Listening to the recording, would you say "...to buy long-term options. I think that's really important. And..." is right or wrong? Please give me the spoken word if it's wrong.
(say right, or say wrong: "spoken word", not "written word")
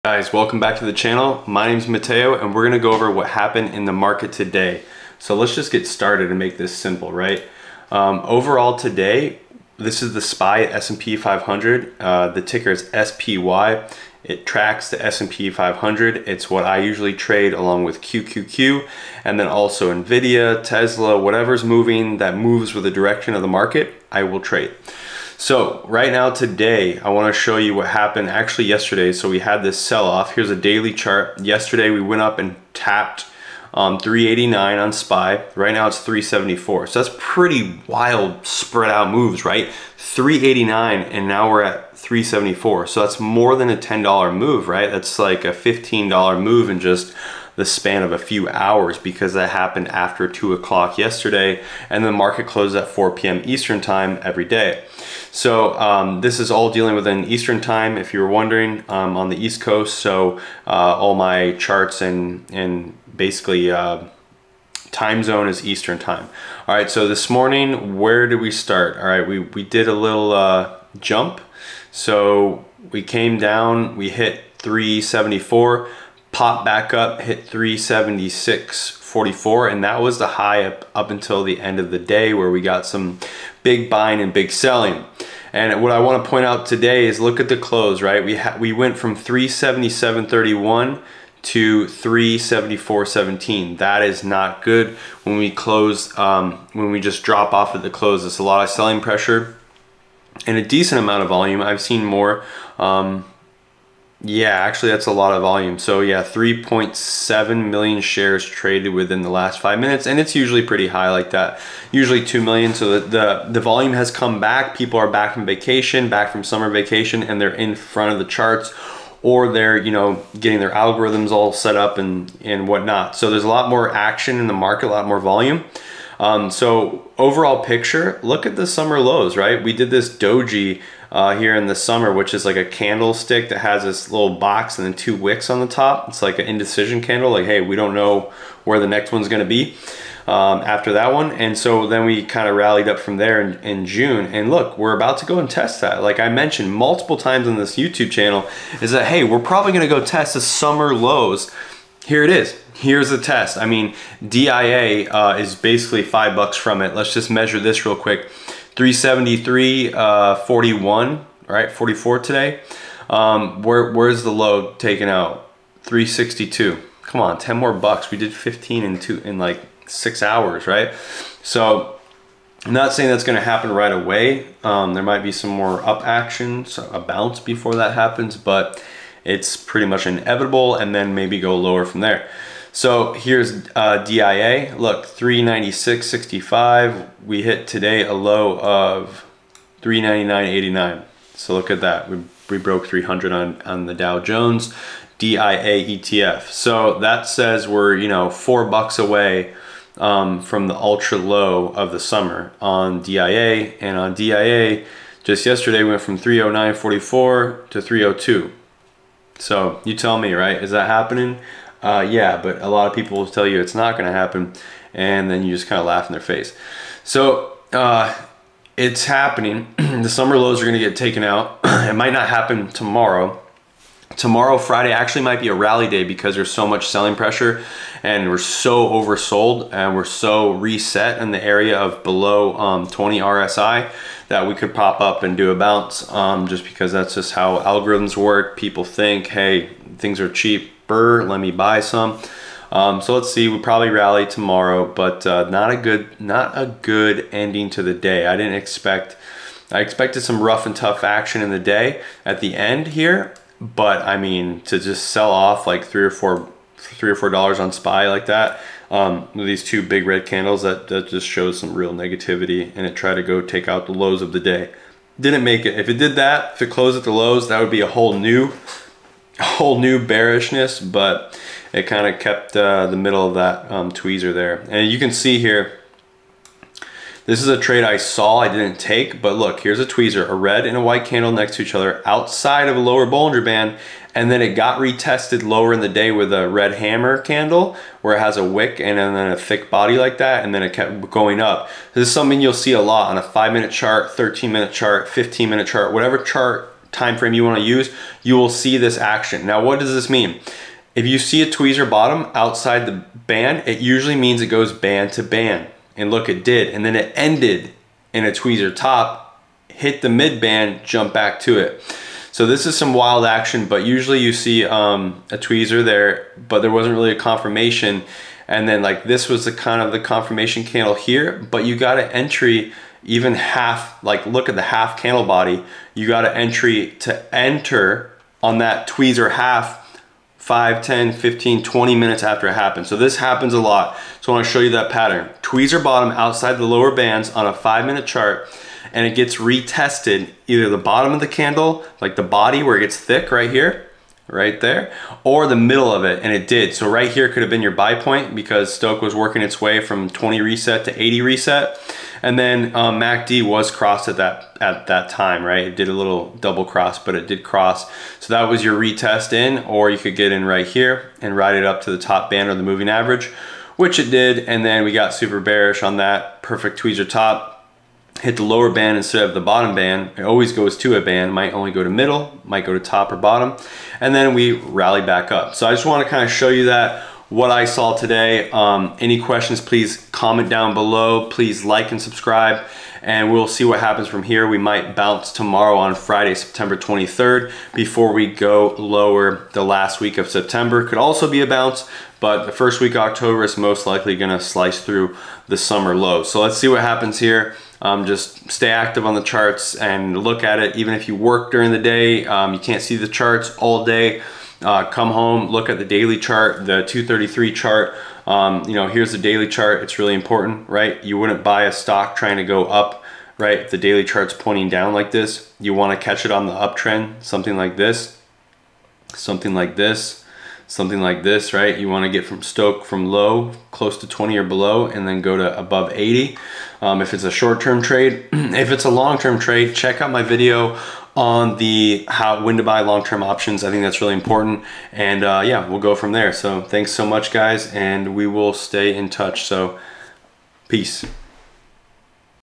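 right.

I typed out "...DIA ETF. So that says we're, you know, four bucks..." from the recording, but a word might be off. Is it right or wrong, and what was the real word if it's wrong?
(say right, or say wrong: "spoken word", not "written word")
right.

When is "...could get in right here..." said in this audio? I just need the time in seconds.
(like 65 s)
359 s.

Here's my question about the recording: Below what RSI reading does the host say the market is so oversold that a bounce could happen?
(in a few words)
20.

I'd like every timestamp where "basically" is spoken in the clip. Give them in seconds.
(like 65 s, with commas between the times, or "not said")
63 s, 155 s.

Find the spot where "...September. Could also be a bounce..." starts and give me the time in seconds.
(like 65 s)
390 s.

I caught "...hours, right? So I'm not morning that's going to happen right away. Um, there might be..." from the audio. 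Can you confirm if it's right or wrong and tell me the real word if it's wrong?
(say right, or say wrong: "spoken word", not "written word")
wrong: "saying", not "morning".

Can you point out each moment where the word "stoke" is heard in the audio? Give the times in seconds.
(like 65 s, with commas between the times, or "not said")
422 s.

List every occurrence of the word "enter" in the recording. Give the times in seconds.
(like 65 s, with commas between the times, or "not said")
327 s.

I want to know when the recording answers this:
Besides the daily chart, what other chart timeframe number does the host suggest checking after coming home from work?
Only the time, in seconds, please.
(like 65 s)
406 s.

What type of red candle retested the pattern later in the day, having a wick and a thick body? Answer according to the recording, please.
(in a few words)
hammer.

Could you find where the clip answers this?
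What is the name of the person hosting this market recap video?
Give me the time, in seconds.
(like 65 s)
1 s.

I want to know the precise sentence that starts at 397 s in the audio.
Um, just stay active on the charts and look at it.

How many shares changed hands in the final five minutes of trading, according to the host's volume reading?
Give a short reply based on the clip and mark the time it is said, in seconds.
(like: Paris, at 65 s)
3.7 million, at 106 s.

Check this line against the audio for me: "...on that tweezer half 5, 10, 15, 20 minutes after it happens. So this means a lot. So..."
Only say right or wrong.
wrong.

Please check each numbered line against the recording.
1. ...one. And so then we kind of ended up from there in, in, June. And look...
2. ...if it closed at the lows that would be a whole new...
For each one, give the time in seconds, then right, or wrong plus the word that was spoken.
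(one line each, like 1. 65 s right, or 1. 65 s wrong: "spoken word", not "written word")
1. 141 s wrong: "rallied", not "ended"
2. 266 s right.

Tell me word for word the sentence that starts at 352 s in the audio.
And then um, MACD was crossed at that at that time, right?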